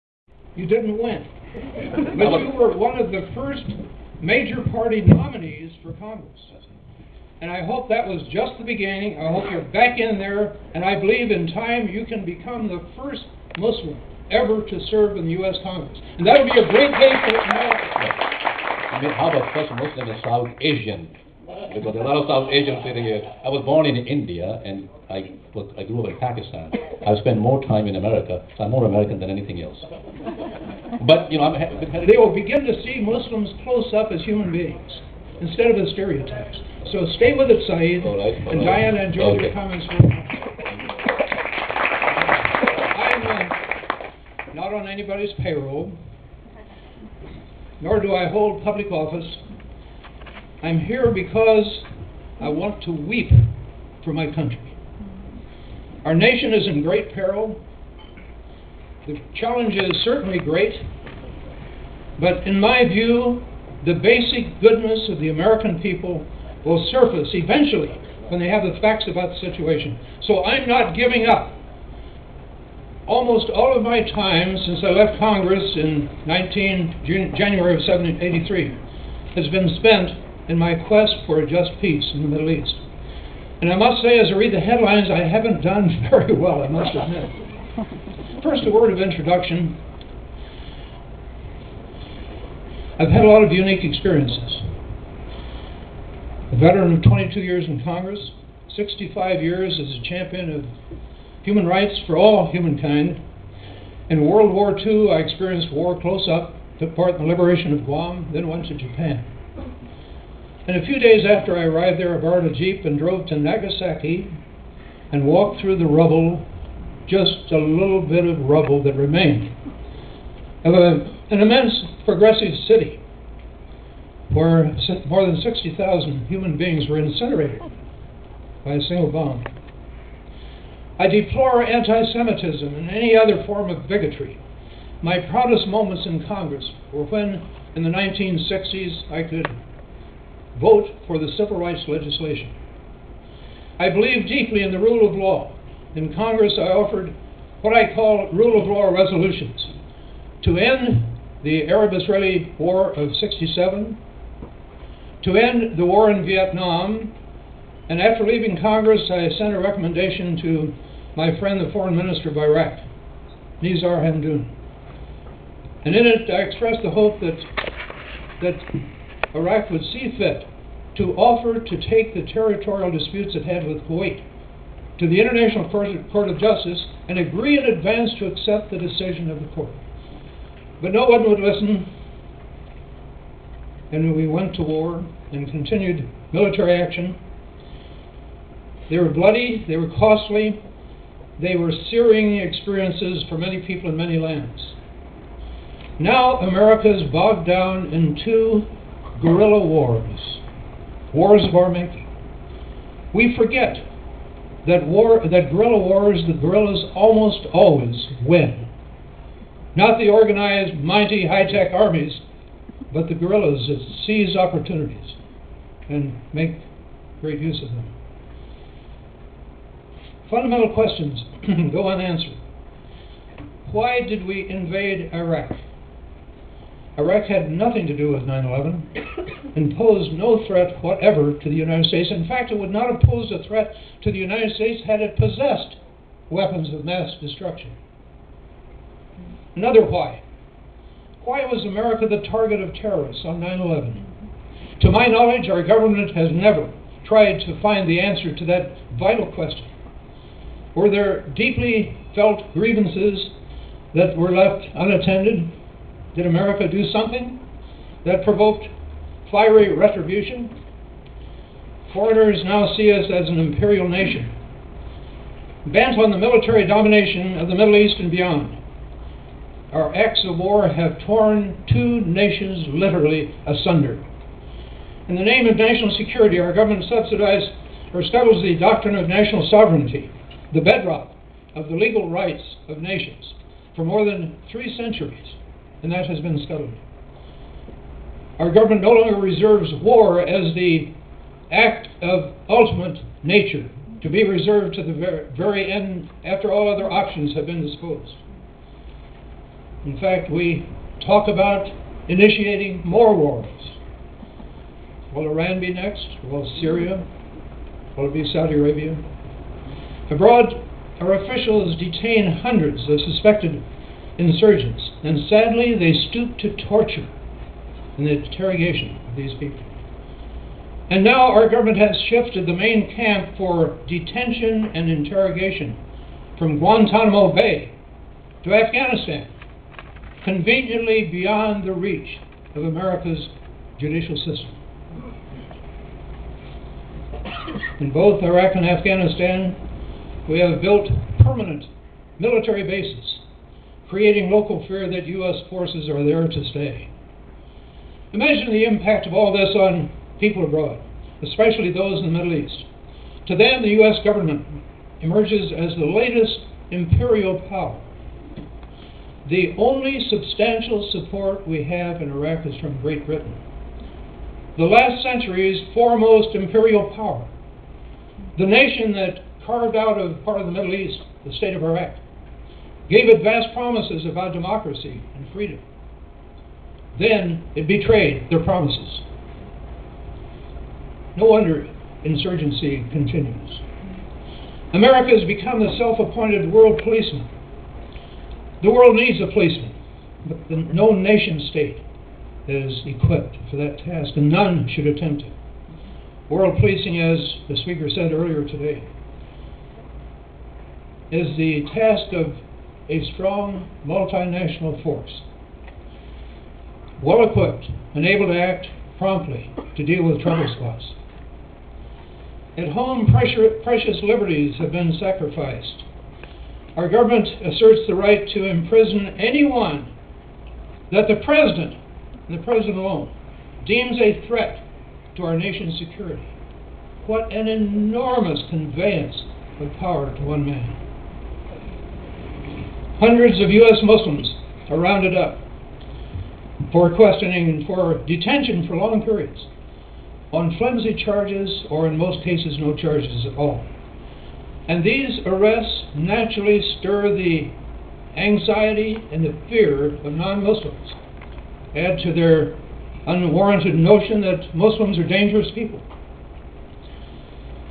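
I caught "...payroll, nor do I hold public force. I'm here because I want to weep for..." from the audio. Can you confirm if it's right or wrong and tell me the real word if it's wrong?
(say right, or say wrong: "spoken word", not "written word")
wrong: "office", not "force".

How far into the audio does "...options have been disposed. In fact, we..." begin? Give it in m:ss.
4:56.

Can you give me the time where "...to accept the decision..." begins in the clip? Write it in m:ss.
2:58.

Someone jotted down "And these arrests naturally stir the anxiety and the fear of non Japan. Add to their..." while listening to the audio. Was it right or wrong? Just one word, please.
wrong.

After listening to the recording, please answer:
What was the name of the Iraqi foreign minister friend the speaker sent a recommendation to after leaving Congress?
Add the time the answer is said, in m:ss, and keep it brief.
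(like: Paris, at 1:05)
Nizar Hamdoun, at 2:43.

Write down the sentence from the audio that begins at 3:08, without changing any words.
They were bloody, they were costly, they were searing experiences for many people in many lands.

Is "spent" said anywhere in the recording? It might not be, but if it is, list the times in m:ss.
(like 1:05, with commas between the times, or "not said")
0:27, 1:19.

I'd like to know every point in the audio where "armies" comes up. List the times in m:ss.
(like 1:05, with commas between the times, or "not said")
3:31.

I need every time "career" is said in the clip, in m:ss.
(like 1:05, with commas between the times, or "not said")
not said.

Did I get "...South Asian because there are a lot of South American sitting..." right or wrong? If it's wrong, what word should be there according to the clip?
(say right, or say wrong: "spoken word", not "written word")
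wrong: "Asians", not "American".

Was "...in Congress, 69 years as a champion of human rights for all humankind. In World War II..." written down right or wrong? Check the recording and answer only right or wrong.
wrong.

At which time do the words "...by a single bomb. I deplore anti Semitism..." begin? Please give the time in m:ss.
2:08.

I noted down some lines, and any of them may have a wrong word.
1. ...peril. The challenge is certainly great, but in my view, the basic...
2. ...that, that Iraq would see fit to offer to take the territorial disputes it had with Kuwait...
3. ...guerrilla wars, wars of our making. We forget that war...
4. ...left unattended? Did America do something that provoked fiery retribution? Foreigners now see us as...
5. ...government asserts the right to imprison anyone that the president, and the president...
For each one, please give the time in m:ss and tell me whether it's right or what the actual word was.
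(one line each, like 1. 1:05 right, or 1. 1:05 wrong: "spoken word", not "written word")
1. 0:57 right
2. 2:47 right
3. 3:19 right
4. 4:14 right
5. 6:56 right.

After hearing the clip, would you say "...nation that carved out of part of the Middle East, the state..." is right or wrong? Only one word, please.
right.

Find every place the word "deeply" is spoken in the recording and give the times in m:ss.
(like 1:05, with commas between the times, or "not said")
2:24, 4:11.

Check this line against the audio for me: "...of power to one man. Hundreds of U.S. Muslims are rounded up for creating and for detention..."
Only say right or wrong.
wrong.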